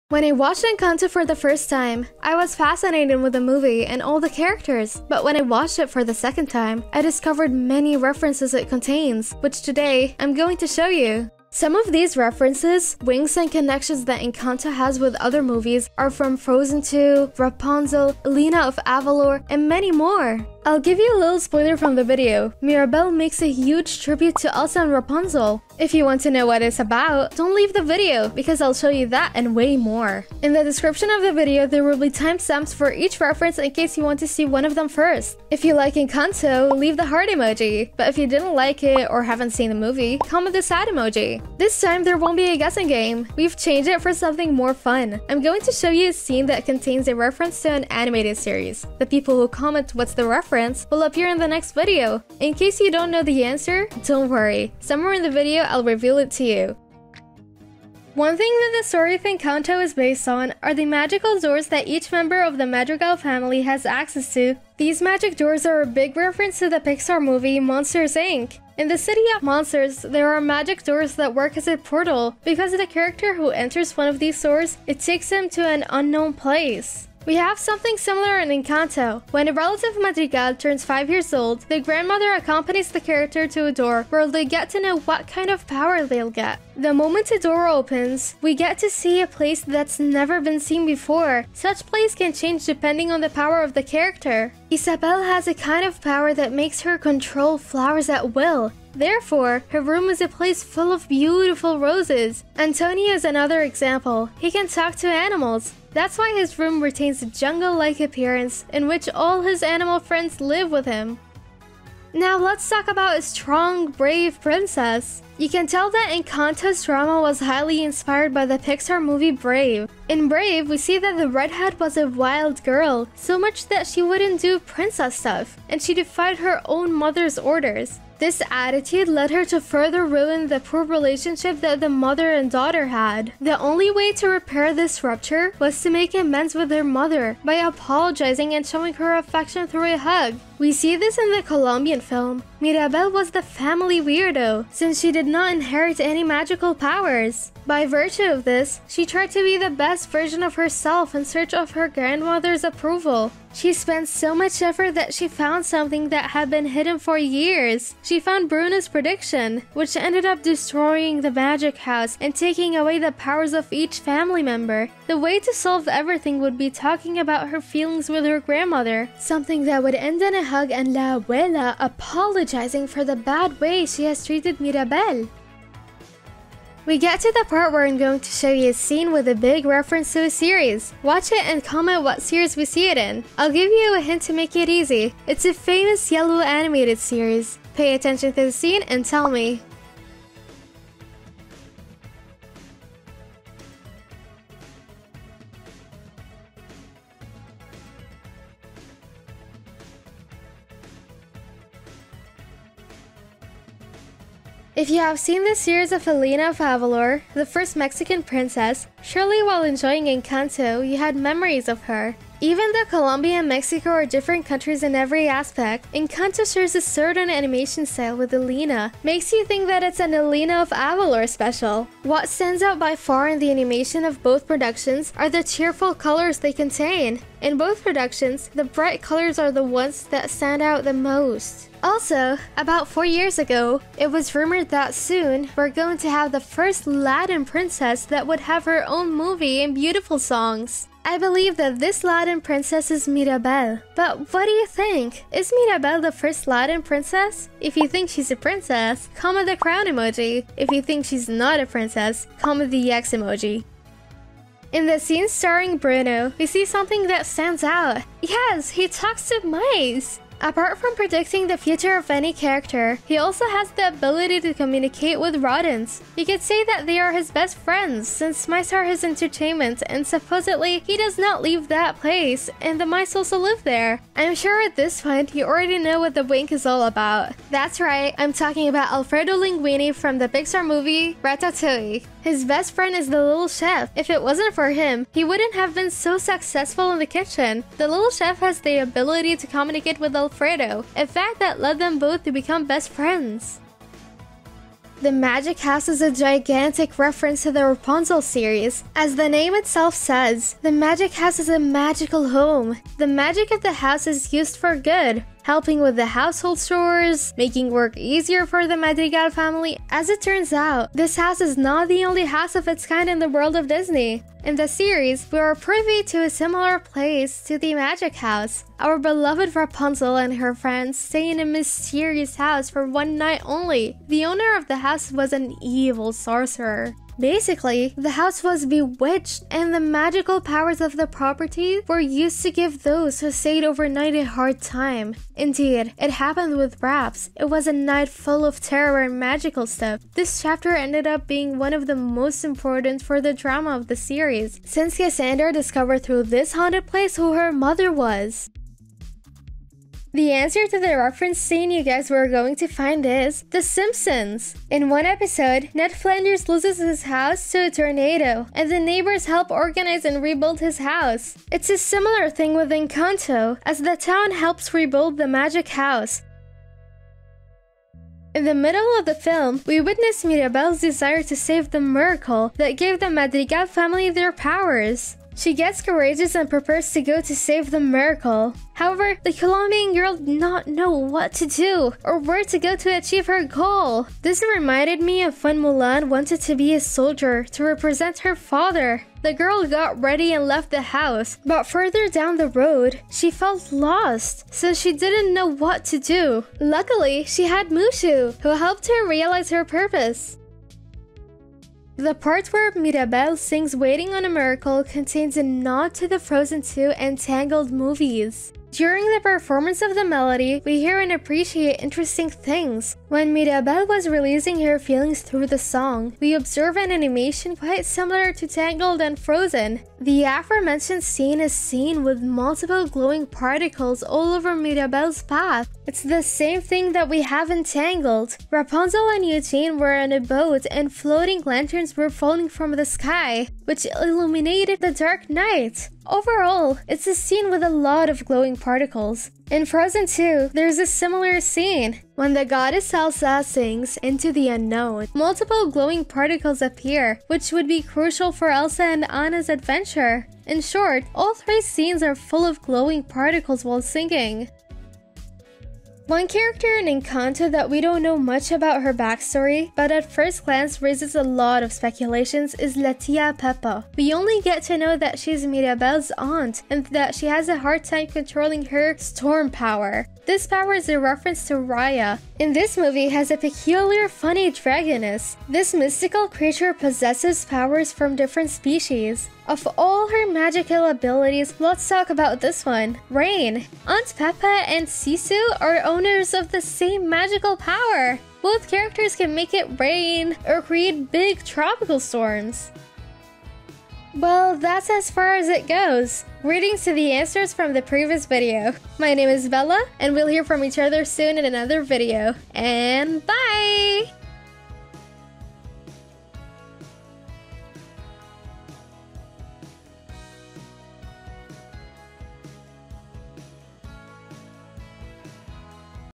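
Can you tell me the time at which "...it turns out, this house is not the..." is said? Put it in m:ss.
5:10.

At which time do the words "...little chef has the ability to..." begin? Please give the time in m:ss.
4:47.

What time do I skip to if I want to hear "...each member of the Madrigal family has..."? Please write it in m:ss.
1:01.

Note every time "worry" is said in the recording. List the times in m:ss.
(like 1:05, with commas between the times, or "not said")
0:54.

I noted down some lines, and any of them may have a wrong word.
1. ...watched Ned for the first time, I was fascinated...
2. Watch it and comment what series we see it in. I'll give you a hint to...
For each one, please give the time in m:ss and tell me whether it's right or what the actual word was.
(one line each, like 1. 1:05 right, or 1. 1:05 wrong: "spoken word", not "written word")
1. 0:00 wrong: "Encanto", not "Ned"
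2. 3:01 right.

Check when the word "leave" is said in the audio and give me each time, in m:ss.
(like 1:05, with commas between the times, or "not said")
0:27, 0:36, 4:31.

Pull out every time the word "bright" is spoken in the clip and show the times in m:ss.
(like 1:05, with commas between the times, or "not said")
3:48.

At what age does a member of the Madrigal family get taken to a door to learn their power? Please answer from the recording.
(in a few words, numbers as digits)
5.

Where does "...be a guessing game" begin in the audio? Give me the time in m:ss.
0:42.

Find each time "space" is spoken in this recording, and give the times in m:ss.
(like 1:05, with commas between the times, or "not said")
not said.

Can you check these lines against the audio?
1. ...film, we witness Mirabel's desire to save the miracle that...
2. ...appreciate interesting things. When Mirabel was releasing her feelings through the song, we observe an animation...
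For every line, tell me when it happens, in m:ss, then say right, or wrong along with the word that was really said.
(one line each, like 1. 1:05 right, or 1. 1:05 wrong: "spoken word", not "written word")
1. 6:09 right
2. 6:51 right.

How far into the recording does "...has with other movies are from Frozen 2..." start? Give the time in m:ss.
0:14.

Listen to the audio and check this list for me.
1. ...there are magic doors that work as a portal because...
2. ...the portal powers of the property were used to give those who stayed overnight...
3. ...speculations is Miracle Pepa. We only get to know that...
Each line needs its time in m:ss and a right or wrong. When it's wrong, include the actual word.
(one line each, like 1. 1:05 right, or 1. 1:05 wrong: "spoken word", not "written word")
1. 1:10 right
2. 5:29 wrong: "magical", not "portal"
3. 7:41 wrong: "Letia", not "Miracle".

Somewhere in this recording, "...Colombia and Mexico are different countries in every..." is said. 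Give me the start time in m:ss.
3:32.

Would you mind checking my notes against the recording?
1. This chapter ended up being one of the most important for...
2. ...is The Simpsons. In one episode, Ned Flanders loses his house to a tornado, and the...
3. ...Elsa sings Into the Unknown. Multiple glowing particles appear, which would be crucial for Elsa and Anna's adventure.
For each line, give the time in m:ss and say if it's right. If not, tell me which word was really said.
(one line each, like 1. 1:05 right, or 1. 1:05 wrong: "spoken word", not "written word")
1. 5:40 right
2. 5:53 right
3. 7:22 right.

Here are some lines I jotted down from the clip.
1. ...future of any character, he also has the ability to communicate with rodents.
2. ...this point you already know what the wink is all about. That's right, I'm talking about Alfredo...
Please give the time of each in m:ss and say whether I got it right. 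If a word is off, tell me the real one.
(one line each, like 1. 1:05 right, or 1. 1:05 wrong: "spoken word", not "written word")
1. 4:21 right
2. 4:34 right.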